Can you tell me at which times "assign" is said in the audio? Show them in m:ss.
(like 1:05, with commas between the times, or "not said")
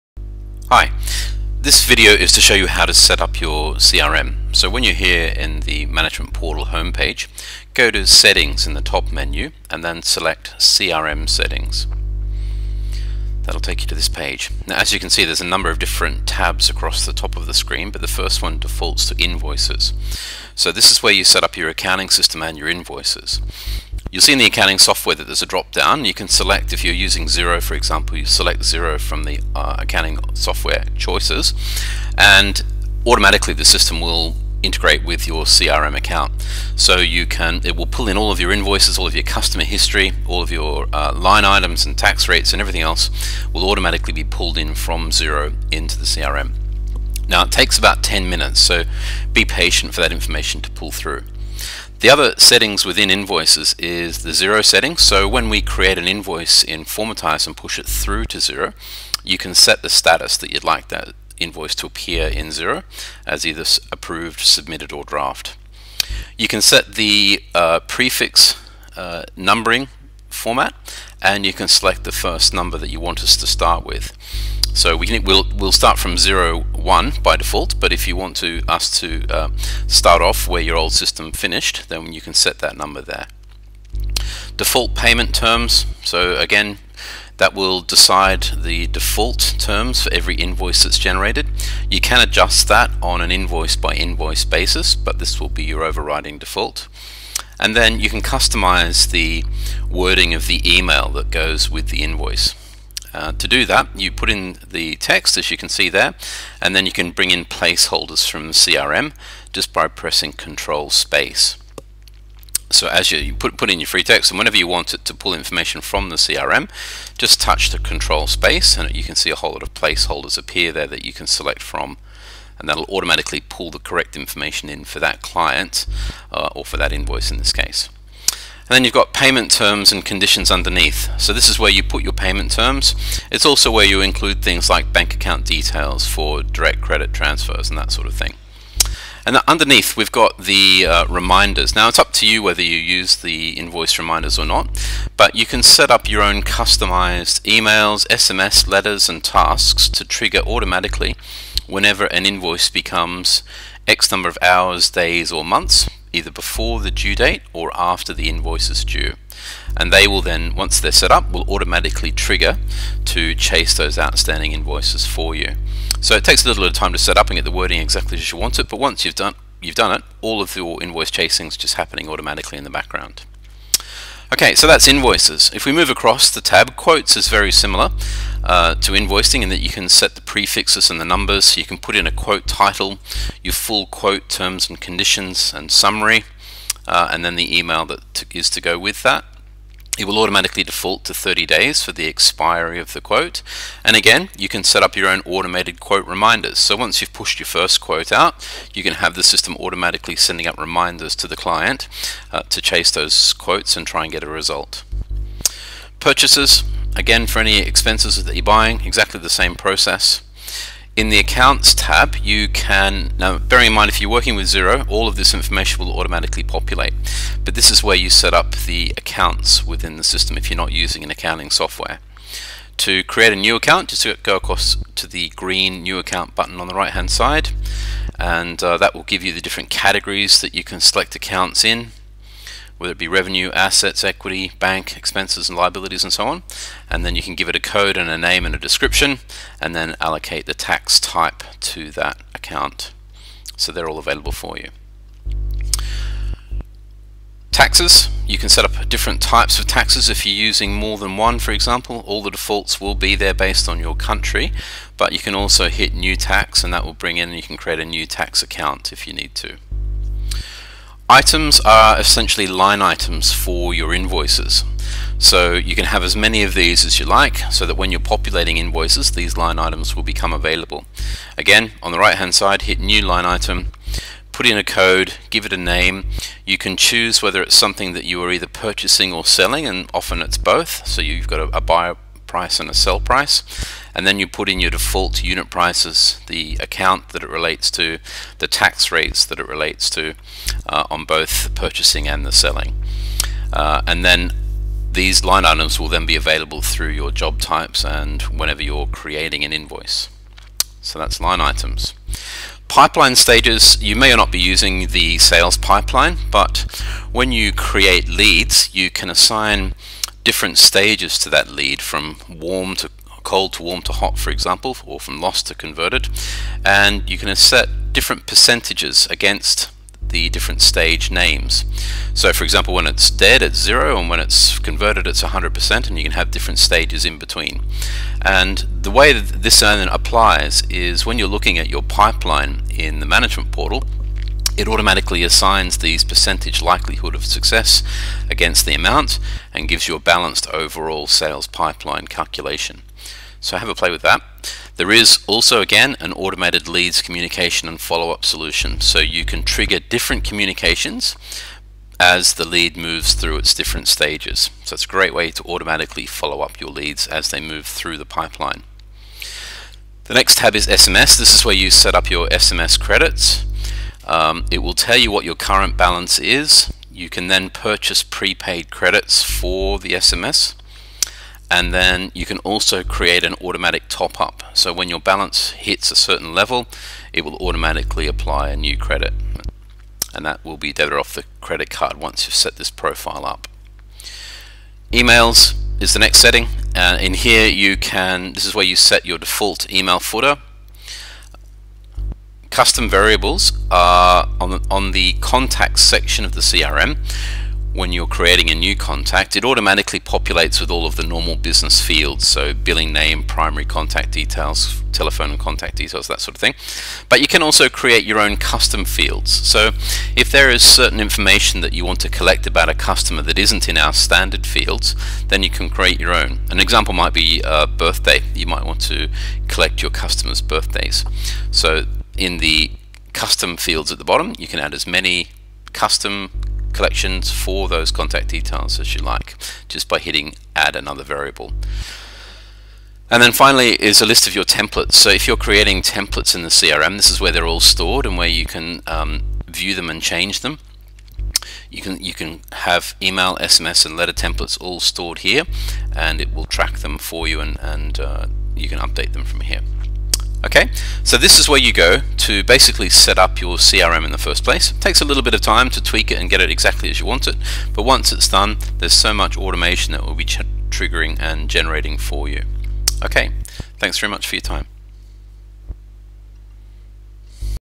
5:09, 5:35.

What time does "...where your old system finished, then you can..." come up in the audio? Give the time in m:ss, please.
1:20.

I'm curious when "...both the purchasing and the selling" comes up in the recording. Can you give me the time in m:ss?
4:51.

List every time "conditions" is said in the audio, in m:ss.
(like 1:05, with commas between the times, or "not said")
2:10, 3:04.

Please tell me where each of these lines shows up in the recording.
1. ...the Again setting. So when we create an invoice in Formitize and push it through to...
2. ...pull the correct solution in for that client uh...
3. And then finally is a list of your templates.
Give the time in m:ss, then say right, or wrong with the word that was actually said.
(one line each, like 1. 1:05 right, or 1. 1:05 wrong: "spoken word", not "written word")
1. 0:54 wrong: "Xero", not "Again"
2. 2:03 wrong: "information", not "solution"
3. 7:13 right.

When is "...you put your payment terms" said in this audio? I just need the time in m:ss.
2:11.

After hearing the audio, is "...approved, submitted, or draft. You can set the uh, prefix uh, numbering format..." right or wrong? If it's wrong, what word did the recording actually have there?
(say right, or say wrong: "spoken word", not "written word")
right.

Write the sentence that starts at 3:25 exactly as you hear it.
Purchases, Again, for any expenses that you're buying, exactly the same process.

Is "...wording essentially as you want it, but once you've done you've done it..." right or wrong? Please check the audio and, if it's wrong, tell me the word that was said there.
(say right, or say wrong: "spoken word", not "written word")
wrong: "exactly", not "essentially".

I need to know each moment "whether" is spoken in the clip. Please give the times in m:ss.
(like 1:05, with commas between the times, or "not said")
2:22, 3:52, 4:37.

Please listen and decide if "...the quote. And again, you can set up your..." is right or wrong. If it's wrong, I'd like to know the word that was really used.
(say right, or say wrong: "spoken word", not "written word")
right.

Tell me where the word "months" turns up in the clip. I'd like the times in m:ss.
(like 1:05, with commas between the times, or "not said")
2:35.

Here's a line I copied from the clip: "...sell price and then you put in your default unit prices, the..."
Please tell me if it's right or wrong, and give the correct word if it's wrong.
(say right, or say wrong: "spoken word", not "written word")
right.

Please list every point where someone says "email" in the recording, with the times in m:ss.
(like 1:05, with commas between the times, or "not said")
1:40, 2:27, 3:07, 6:24, 6:29, 7:23.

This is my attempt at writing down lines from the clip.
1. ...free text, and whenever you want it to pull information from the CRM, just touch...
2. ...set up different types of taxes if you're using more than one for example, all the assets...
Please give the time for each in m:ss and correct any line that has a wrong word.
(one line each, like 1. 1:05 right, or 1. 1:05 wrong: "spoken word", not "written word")
1. 1:53 right
2. 4:08 wrong: "defaults", not "assets".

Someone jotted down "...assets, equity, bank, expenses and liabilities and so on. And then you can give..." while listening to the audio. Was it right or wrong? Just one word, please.
right.